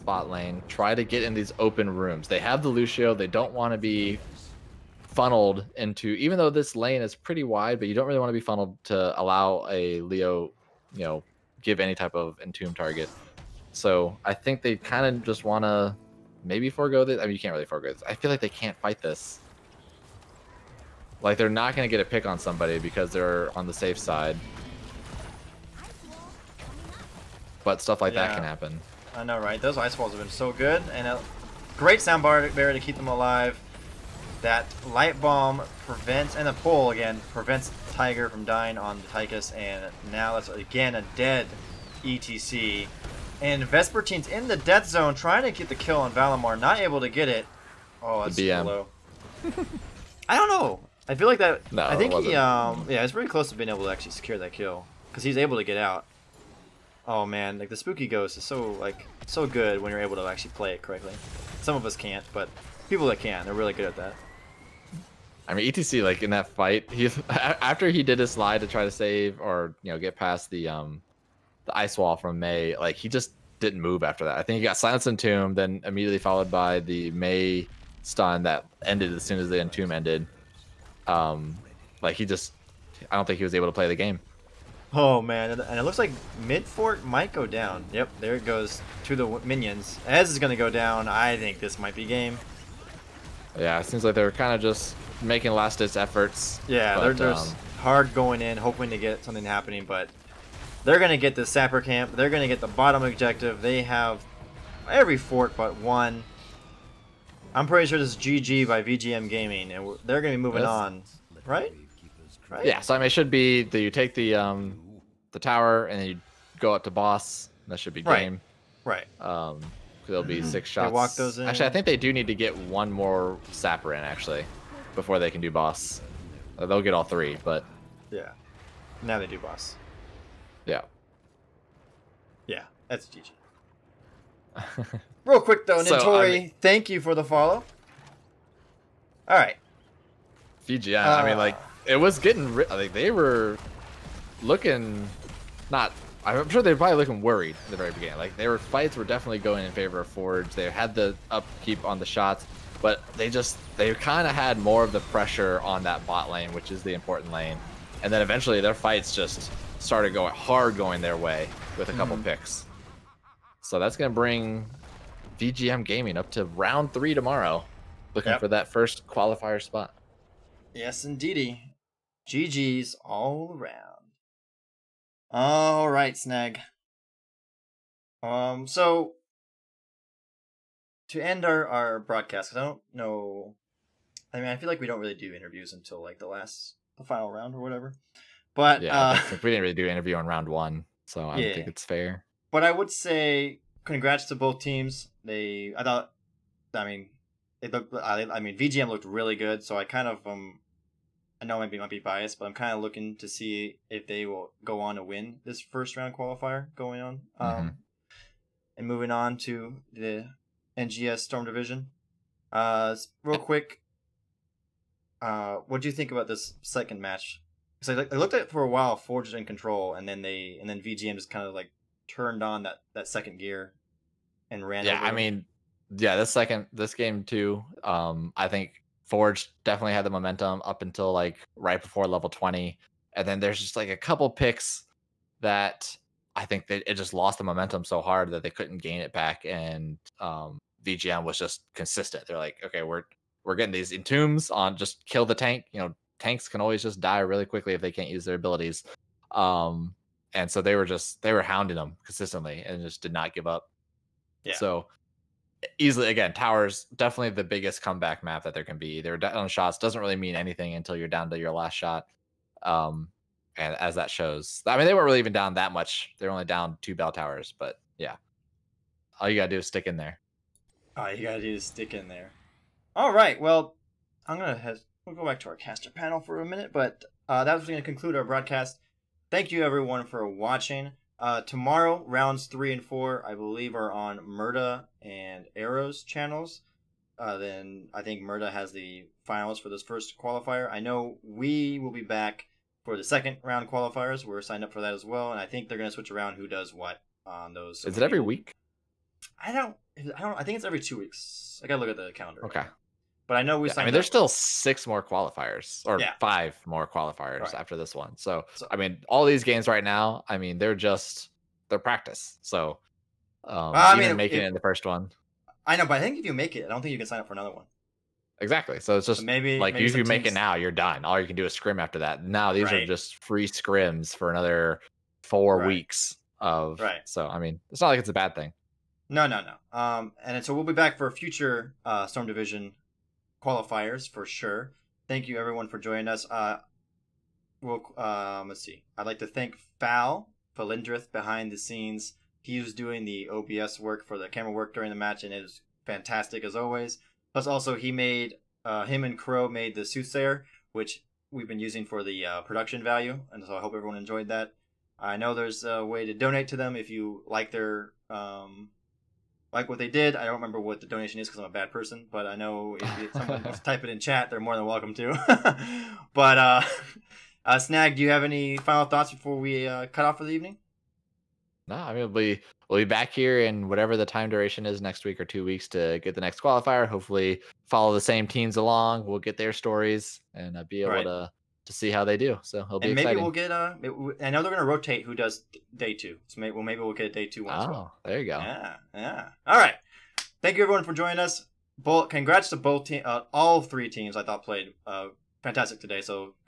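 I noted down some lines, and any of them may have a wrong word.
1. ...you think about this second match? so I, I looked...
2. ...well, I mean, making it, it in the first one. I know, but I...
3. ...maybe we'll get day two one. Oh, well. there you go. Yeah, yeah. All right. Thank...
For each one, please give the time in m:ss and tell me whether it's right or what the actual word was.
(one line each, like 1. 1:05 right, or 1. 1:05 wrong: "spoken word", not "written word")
1. 3:35 right
2. 5:13 right
3. 6:26 right.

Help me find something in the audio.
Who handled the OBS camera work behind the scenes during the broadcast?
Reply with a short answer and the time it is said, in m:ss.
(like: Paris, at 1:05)
Falindrith, at 5:40.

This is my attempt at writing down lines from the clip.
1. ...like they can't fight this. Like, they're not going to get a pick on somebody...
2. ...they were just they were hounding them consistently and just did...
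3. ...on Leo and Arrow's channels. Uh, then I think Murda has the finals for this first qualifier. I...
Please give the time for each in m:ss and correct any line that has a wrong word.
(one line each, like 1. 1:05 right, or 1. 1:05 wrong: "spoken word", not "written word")
1. 0:18 right
2. 4:10 right
3. 4:43 wrong: "Murda", not "Leo".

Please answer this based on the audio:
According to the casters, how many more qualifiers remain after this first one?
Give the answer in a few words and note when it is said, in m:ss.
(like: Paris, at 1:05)
5, at 5:06.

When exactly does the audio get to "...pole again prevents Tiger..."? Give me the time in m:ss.
0:36.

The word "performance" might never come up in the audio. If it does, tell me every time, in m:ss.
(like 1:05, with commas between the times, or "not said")
not said.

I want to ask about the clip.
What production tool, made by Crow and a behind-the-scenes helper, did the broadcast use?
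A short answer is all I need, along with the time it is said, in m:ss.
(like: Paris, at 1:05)
the soothsayer, at 5:49.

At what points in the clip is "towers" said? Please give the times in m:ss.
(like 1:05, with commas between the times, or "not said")
1:55, 4:16, 4:27.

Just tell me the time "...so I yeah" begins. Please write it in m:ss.
3:11.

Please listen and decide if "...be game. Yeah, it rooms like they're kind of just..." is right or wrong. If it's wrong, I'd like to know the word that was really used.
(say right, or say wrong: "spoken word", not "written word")
wrong: "seems", not "rooms".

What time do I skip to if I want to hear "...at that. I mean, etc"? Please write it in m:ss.
1:03.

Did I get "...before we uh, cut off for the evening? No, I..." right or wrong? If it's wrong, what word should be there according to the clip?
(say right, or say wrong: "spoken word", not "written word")
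right.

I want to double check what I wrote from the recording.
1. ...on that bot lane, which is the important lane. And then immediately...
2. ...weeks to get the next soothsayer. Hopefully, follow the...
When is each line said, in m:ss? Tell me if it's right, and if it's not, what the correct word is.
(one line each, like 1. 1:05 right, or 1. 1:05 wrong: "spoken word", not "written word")
1. 2:35 wrong: "eventually", not "immediately"
2. 6:15 wrong: "qualifier", not "soothsayer".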